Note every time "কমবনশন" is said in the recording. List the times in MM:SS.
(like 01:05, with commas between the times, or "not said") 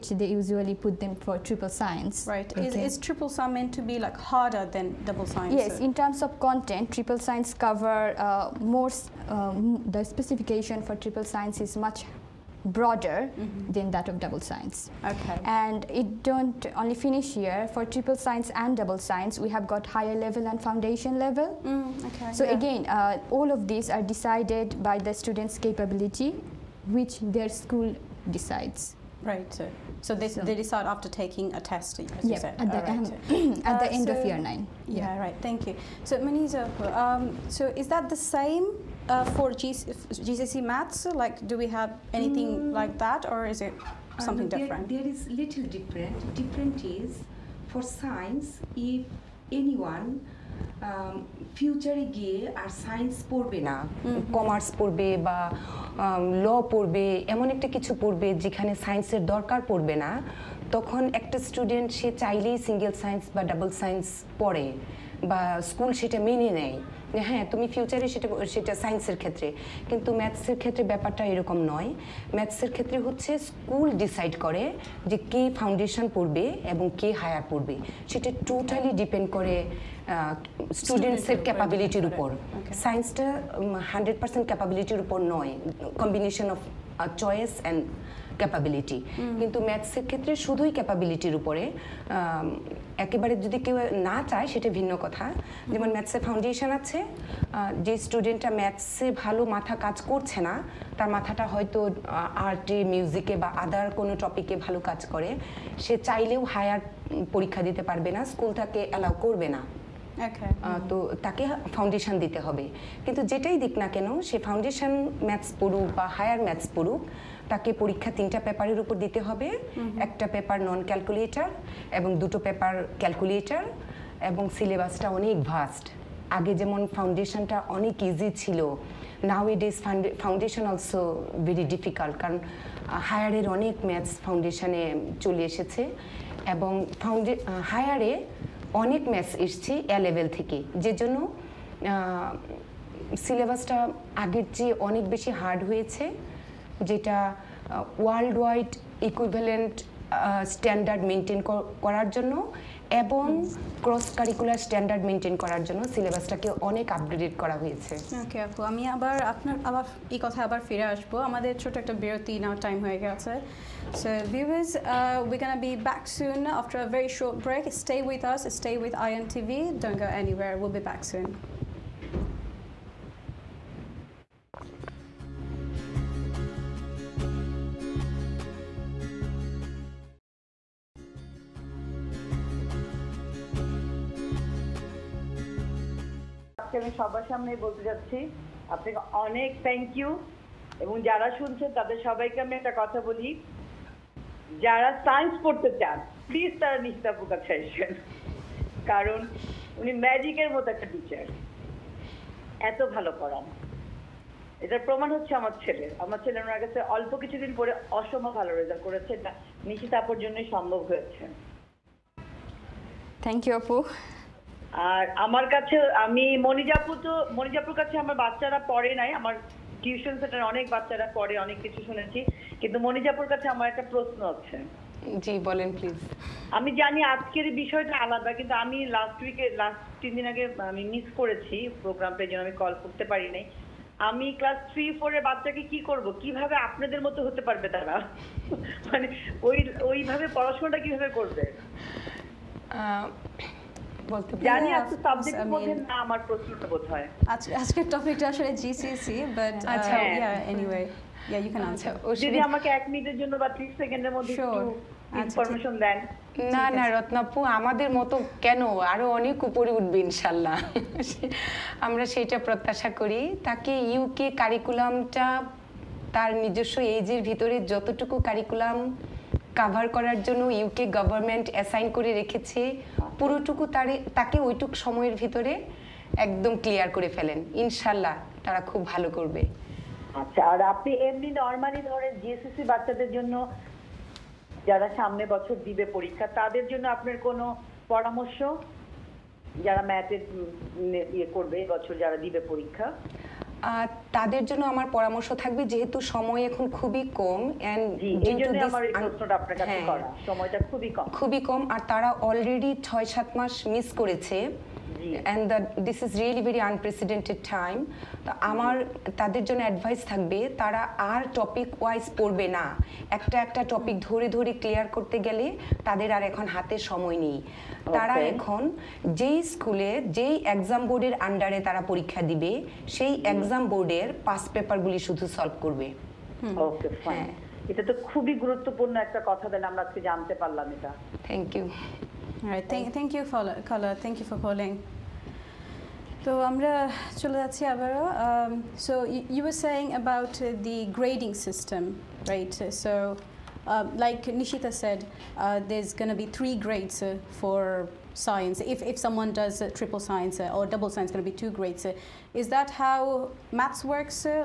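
01:26.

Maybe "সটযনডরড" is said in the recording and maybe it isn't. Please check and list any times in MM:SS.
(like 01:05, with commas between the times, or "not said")
02:30, 02:34.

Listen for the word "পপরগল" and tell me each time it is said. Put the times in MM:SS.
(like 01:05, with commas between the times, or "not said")
05:24.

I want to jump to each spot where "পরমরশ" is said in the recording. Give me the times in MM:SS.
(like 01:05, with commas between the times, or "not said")
04:47, 04:54.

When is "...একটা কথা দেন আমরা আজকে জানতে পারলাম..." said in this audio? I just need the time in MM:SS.
05:29.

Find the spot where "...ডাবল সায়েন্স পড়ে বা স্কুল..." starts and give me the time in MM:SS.
01:03.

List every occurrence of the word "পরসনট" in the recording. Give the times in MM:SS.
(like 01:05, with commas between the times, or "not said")
01:24.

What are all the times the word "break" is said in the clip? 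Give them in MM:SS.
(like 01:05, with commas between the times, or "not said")
02:47.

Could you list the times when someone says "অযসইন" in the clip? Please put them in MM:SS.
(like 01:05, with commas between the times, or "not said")
04:31.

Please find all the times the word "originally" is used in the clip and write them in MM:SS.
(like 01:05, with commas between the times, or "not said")
not said.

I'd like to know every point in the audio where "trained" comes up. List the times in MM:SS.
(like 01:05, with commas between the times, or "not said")
not said.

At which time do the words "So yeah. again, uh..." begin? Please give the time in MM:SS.
00:22.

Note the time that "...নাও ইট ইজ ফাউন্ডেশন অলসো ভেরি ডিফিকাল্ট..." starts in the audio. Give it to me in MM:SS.
02:09.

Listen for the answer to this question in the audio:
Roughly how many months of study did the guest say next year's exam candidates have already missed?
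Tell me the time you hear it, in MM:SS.
05:02.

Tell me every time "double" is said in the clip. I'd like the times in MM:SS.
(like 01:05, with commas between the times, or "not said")
00:05, 00:14, 00:18, 05:50.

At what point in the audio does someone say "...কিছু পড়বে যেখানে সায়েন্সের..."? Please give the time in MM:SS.
00:57.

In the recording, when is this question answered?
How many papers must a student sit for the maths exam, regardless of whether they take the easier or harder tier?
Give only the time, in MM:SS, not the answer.
01:58.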